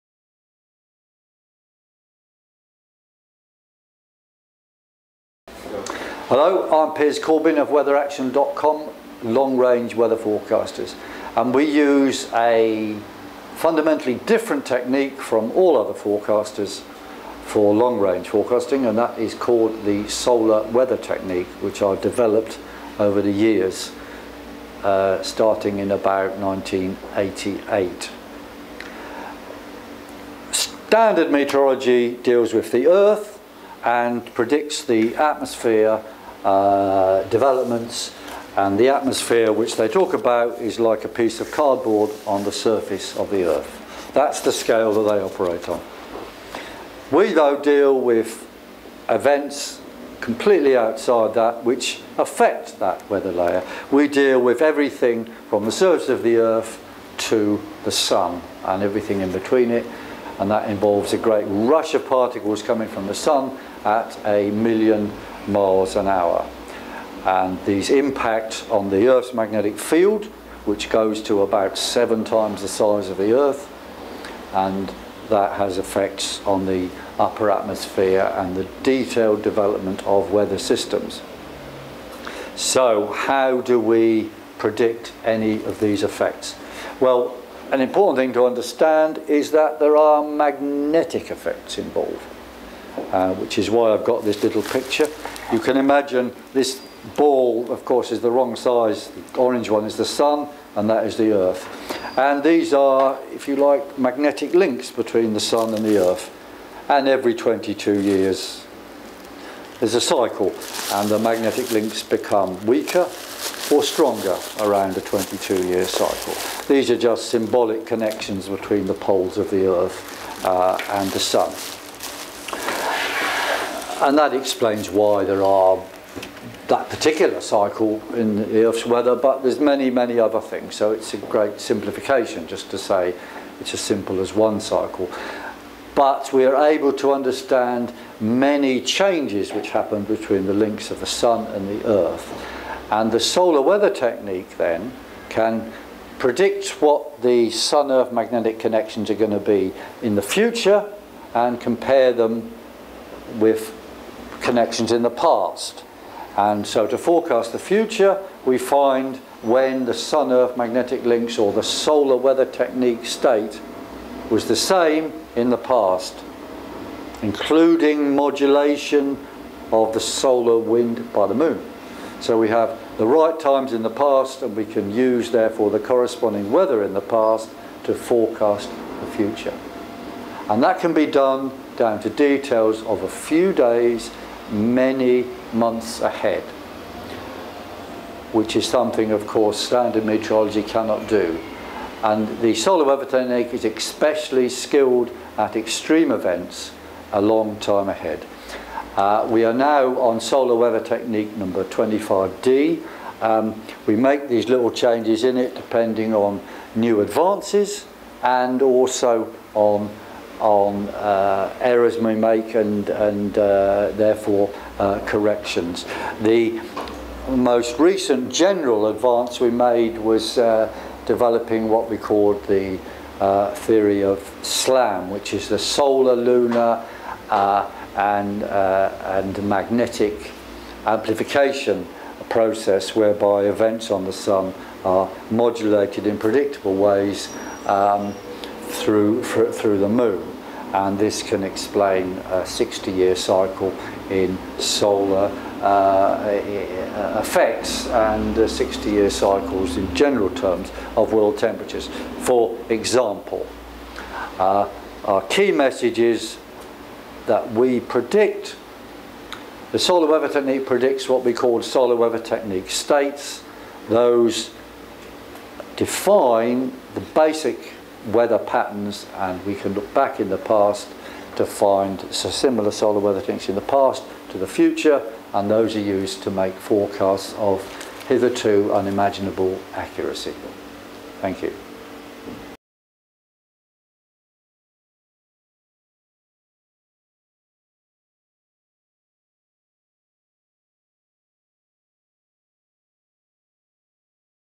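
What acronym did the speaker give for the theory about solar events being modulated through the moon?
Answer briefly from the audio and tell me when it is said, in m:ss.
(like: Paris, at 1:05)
SLAM, at 3:44.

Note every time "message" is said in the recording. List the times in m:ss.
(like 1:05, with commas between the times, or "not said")
4:15.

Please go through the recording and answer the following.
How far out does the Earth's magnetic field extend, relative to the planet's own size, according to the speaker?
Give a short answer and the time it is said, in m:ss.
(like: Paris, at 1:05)
7 times, at 1:11.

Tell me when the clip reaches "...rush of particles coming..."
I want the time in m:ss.
1:01.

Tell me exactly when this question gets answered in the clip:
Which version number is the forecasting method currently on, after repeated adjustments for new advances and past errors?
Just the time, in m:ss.
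3:21.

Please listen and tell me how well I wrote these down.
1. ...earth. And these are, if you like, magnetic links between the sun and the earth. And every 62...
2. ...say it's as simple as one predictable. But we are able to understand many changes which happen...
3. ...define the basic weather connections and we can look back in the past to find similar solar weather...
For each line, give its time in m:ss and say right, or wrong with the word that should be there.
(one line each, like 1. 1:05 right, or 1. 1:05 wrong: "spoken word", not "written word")
1. 1:41 wrong: "22", not "62"
2. 2:12 wrong: "cycle", not "predictable"
3. 4:25 wrong: "patterns", not "connections".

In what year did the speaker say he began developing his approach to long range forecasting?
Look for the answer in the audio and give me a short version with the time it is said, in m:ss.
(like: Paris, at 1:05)
1988, at 0:26.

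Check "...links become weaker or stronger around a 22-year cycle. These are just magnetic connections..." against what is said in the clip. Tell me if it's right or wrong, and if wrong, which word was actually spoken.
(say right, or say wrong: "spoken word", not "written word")
wrong: "symbolic", not "magnetic".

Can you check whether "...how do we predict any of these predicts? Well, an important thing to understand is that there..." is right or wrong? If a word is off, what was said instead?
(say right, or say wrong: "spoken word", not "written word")
wrong: "effects", not "predicts".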